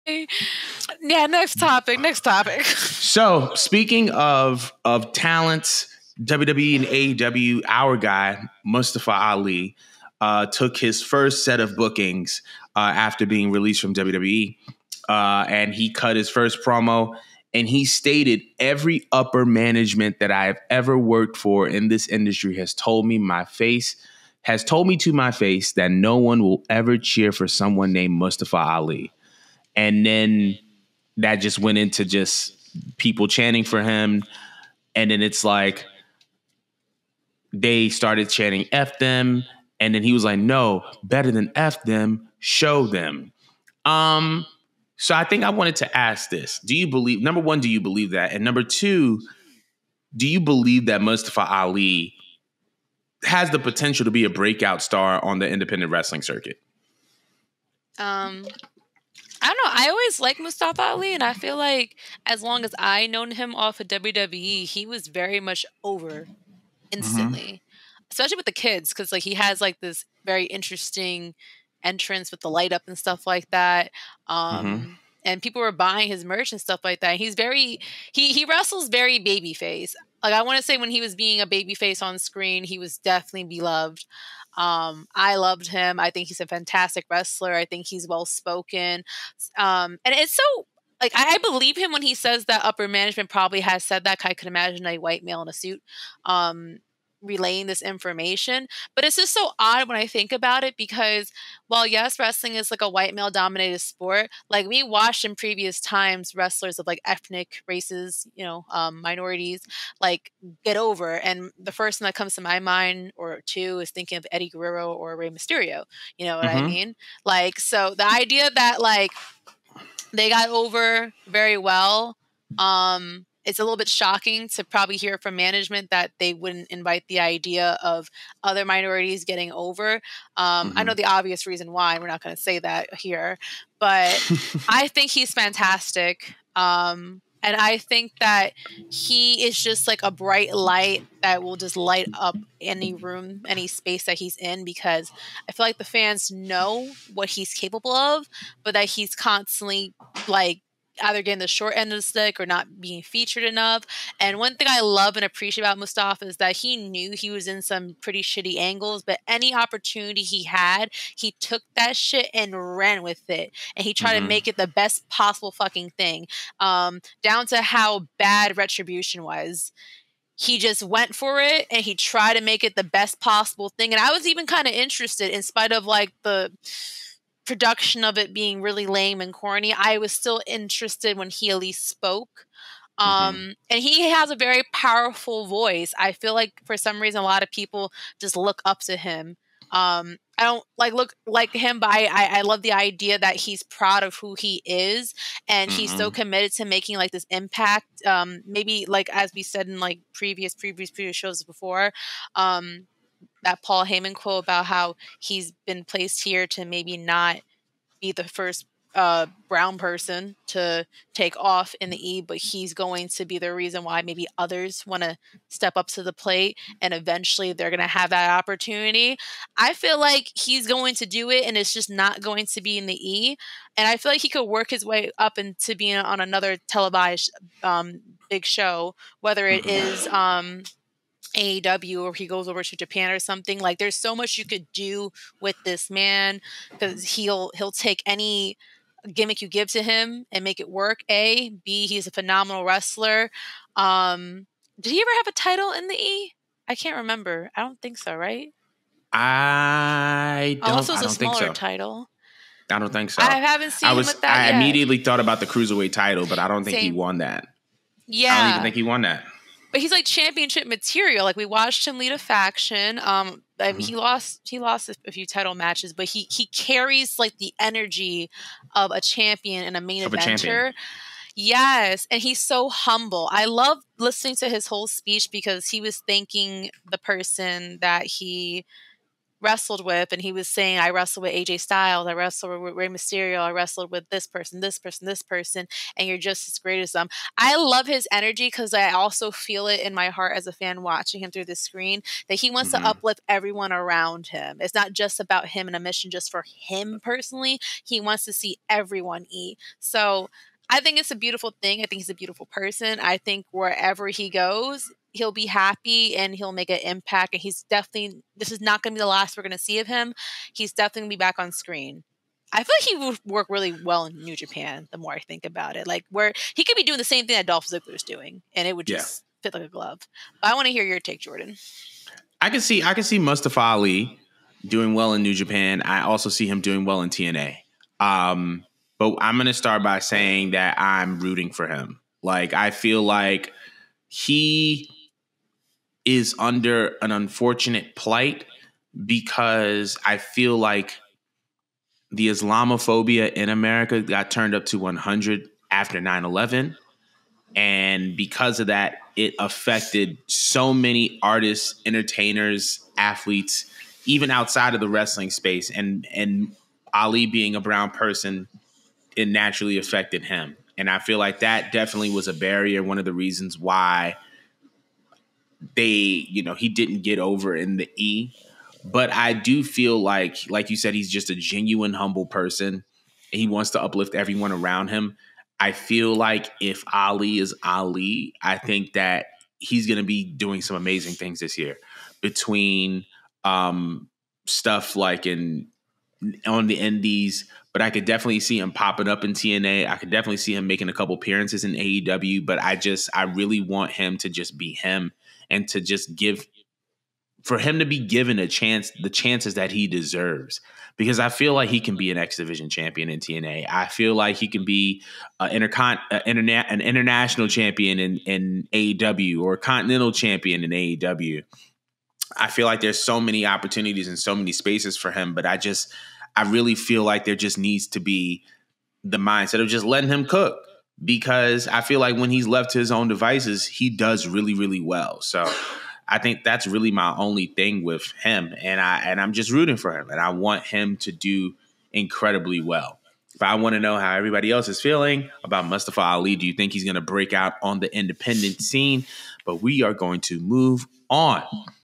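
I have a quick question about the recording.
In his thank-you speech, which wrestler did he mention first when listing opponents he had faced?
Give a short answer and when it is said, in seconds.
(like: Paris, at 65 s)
AJ Styles, at 281 s.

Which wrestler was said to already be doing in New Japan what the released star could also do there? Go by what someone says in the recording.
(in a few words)
Dolph Ziggler.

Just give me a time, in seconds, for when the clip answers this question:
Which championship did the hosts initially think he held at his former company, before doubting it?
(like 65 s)
255 s.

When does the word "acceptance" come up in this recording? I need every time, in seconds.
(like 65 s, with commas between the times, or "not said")
not said.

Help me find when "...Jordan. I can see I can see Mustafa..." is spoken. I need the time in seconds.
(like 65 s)
321 s.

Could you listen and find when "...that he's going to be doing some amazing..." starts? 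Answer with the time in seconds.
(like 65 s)
378 s.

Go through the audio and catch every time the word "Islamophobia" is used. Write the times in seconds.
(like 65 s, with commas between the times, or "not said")
342 s.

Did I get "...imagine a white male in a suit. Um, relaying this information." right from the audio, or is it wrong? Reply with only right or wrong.
right.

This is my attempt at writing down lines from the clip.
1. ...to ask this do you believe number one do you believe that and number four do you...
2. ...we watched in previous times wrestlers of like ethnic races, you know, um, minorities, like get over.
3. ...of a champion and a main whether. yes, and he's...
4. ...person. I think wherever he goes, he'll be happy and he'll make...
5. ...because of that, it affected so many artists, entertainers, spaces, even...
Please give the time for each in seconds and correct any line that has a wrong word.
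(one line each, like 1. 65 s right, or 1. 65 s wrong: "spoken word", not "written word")
1. 45 s wrong: "two", not "four"
2. 104 s right
3. 268 s wrong: "eventer", not "whether"
4. 302 s right
5. 348 s wrong: "athletes", not "spaces".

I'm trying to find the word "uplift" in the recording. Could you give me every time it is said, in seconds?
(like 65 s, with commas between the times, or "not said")
292 s, 373 s.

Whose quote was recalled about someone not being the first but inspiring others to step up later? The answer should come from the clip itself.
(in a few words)
Paul Heyman.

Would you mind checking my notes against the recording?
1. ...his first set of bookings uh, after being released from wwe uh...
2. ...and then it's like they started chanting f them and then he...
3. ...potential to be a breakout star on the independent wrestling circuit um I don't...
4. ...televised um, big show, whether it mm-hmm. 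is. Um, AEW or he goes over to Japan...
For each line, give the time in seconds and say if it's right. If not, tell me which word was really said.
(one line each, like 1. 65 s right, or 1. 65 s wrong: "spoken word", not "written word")
1. 10 s right
2. 34 s right
3. 53 s right
4. 226 s right.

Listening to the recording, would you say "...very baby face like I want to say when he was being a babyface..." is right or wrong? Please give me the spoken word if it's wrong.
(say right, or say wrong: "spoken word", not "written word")
right.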